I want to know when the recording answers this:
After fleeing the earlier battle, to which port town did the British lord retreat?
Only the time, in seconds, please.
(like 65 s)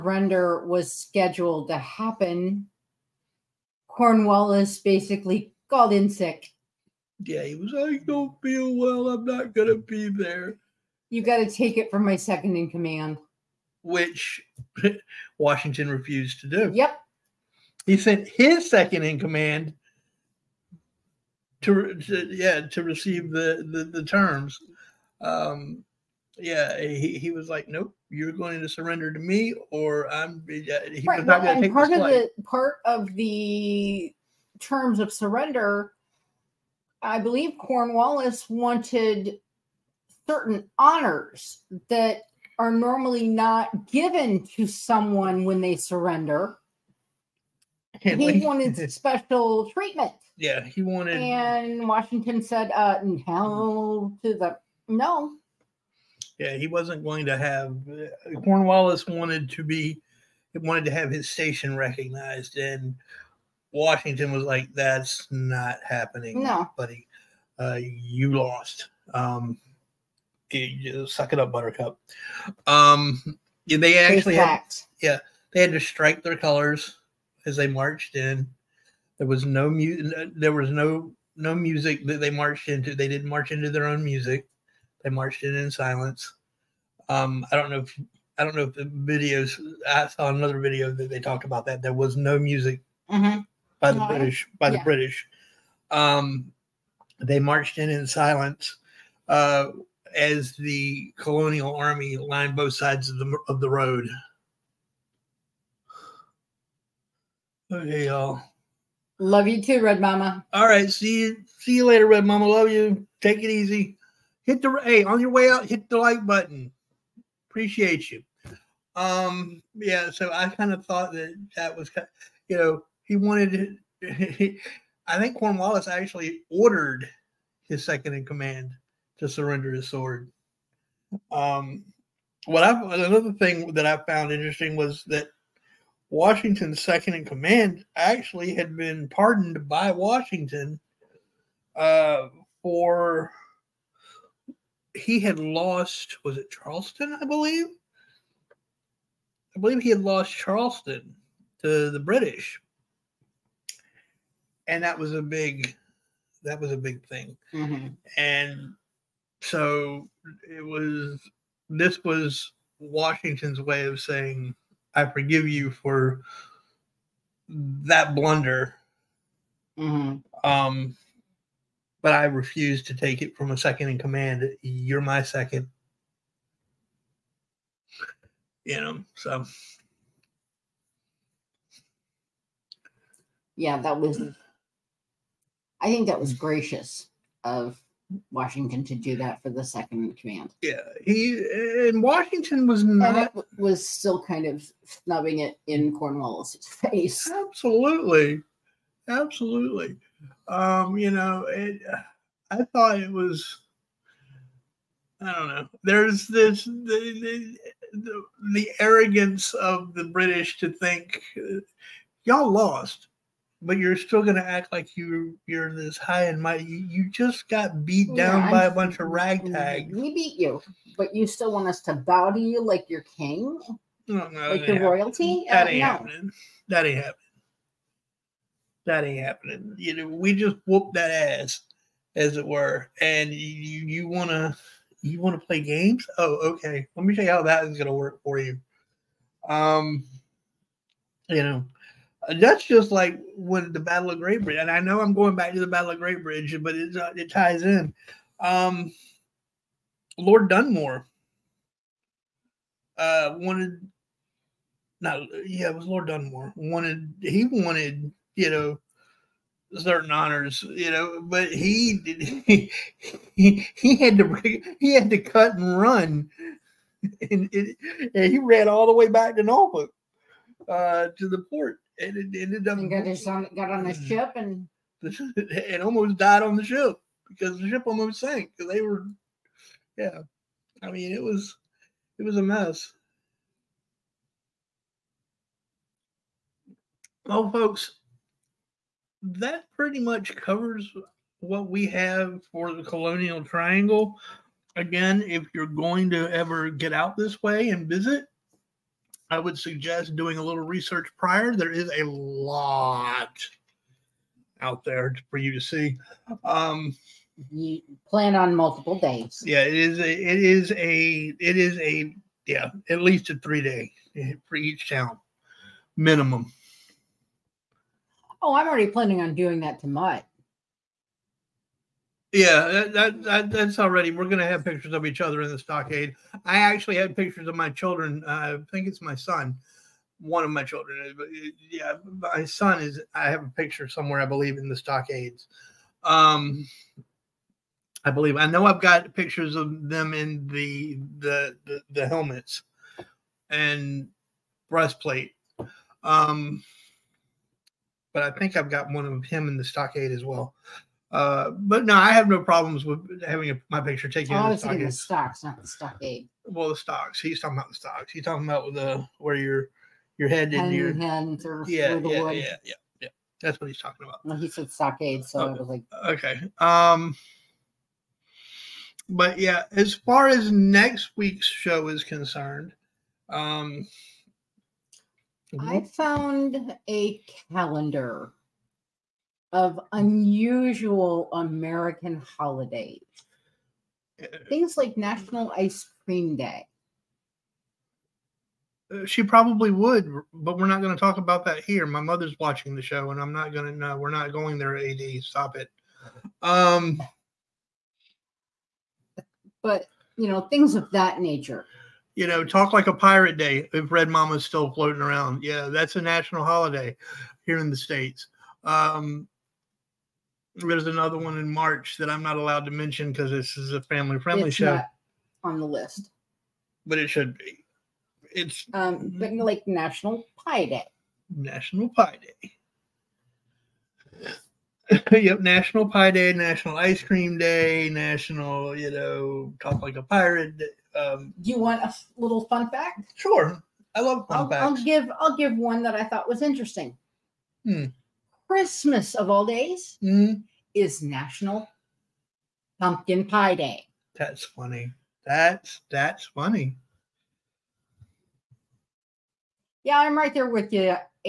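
269 s.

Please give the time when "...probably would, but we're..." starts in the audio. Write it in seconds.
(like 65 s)
389 s.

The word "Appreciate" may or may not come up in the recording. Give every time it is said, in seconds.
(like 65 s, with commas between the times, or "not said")
117 s.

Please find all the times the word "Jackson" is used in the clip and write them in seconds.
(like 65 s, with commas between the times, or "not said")
not said.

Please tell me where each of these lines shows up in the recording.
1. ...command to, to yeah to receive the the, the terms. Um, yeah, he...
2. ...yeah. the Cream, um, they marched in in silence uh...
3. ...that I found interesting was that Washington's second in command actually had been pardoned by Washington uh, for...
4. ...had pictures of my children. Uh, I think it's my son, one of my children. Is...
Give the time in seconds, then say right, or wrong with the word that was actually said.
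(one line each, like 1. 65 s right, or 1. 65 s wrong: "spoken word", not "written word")
1. 19 s right
2. 94 s wrong: "British", not "Cream"
3. 133 s right
4. 326 s right.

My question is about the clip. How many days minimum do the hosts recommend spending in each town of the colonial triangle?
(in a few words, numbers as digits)
3 days.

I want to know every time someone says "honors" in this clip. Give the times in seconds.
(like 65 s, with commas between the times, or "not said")
40 s, 260 s.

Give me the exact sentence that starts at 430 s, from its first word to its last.
Um, Do you want a little fun fact?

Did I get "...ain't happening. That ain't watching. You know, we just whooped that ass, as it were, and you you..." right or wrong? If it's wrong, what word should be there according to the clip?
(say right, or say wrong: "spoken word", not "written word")
wrong: "happening", not "watching".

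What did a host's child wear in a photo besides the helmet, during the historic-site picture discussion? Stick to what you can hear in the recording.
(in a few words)
breastplate.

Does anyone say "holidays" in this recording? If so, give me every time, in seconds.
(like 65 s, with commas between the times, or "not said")
382 s, 406 s.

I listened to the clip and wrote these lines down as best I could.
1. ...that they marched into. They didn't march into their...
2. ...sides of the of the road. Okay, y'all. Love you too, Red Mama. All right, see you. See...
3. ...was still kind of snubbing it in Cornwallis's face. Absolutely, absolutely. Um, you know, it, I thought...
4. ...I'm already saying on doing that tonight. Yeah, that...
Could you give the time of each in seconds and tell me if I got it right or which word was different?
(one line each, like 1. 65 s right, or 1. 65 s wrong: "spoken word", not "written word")
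1. 82 s right
2. 102 s right
3. 193 s right
4. 318 s wrong: "planning", not "saying".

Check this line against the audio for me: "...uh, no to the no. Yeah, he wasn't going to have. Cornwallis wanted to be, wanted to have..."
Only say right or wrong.
right.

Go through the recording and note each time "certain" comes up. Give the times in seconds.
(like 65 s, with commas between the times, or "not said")
40 s, 259 s.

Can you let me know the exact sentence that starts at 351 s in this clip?
Uh, but no, I have no problems with having a, my picture taken.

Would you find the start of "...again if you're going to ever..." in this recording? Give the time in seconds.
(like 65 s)
294 s.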